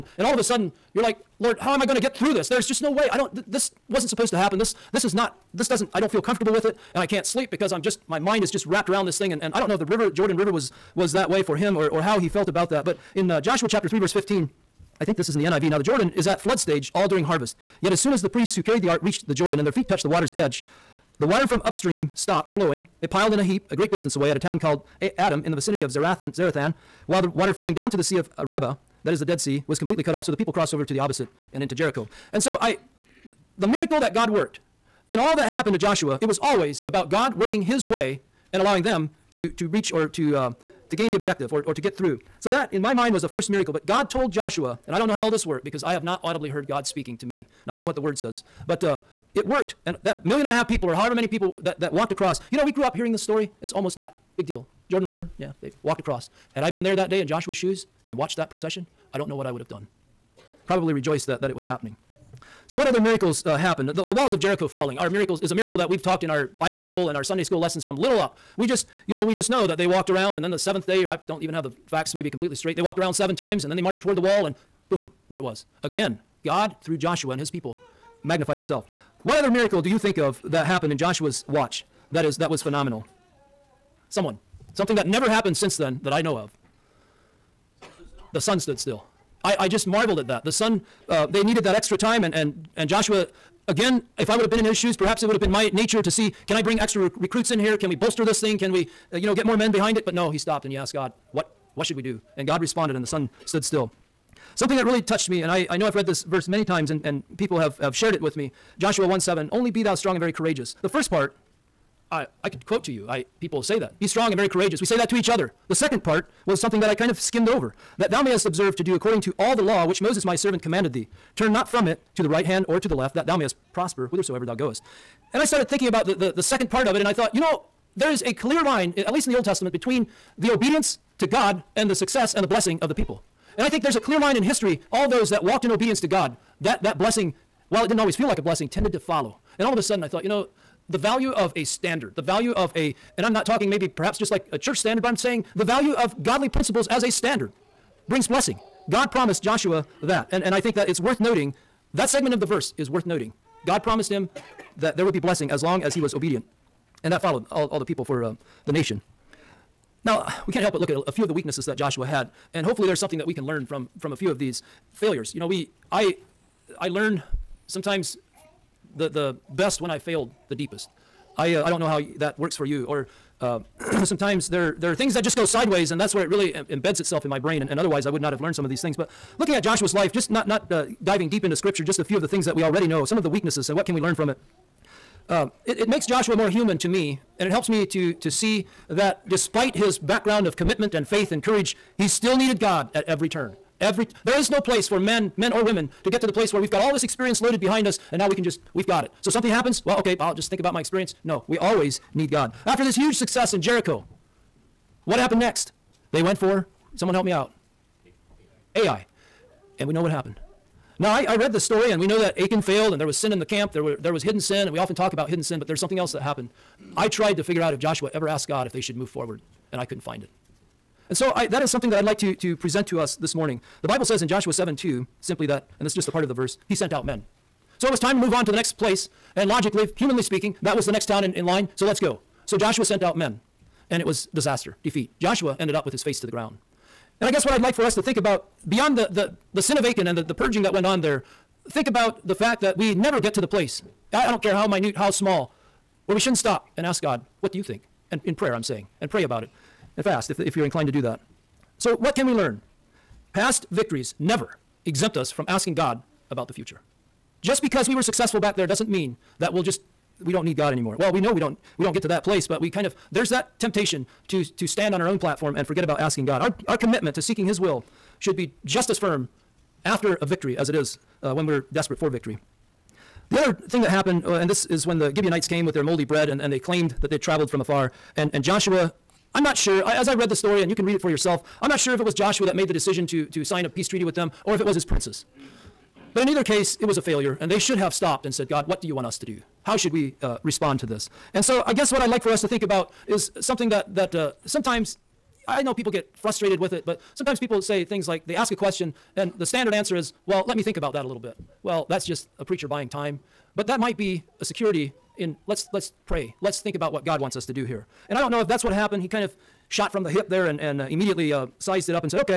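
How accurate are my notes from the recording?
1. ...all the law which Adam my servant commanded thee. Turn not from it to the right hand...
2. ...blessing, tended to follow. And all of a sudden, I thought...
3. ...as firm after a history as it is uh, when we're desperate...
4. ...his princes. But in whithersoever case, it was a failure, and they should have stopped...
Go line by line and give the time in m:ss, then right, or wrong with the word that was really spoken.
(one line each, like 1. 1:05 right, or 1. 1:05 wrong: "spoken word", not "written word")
1. 1:59 wrong: "Moses", not "Adam"
2. 2:18 right
3. 4:28 wrong: "victory", not "history"
4. 4:44 wrong: "either", not "whithersoever".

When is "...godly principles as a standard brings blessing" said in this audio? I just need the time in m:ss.
2:26.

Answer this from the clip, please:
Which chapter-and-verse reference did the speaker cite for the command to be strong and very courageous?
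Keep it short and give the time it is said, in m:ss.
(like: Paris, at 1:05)
Joshua 1:7, at 1:48.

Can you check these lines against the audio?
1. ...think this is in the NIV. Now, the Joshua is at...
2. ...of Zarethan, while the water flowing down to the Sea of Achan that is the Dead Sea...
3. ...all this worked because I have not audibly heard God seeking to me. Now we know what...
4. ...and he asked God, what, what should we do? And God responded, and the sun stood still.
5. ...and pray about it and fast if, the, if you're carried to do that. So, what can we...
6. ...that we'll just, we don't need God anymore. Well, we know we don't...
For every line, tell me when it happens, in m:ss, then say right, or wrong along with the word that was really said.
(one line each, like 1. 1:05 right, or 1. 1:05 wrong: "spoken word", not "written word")
1. 0:15 wrong: "Jordan", not "Joshua"
2. 0:25 wrong: "Arabah", not "Achan"
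3. 0:45 wrong: "speaking", not "seeking"
4. 1:40 right
5. 4:09 wrong: "inclined", not "carried"
6. 4:19 right.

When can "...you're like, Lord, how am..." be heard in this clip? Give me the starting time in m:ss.
0:00.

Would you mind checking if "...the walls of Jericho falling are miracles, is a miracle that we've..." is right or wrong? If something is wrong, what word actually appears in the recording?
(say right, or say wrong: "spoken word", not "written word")
right.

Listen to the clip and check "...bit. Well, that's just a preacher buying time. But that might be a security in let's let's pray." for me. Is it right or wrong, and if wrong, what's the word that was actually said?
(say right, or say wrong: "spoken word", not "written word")
right.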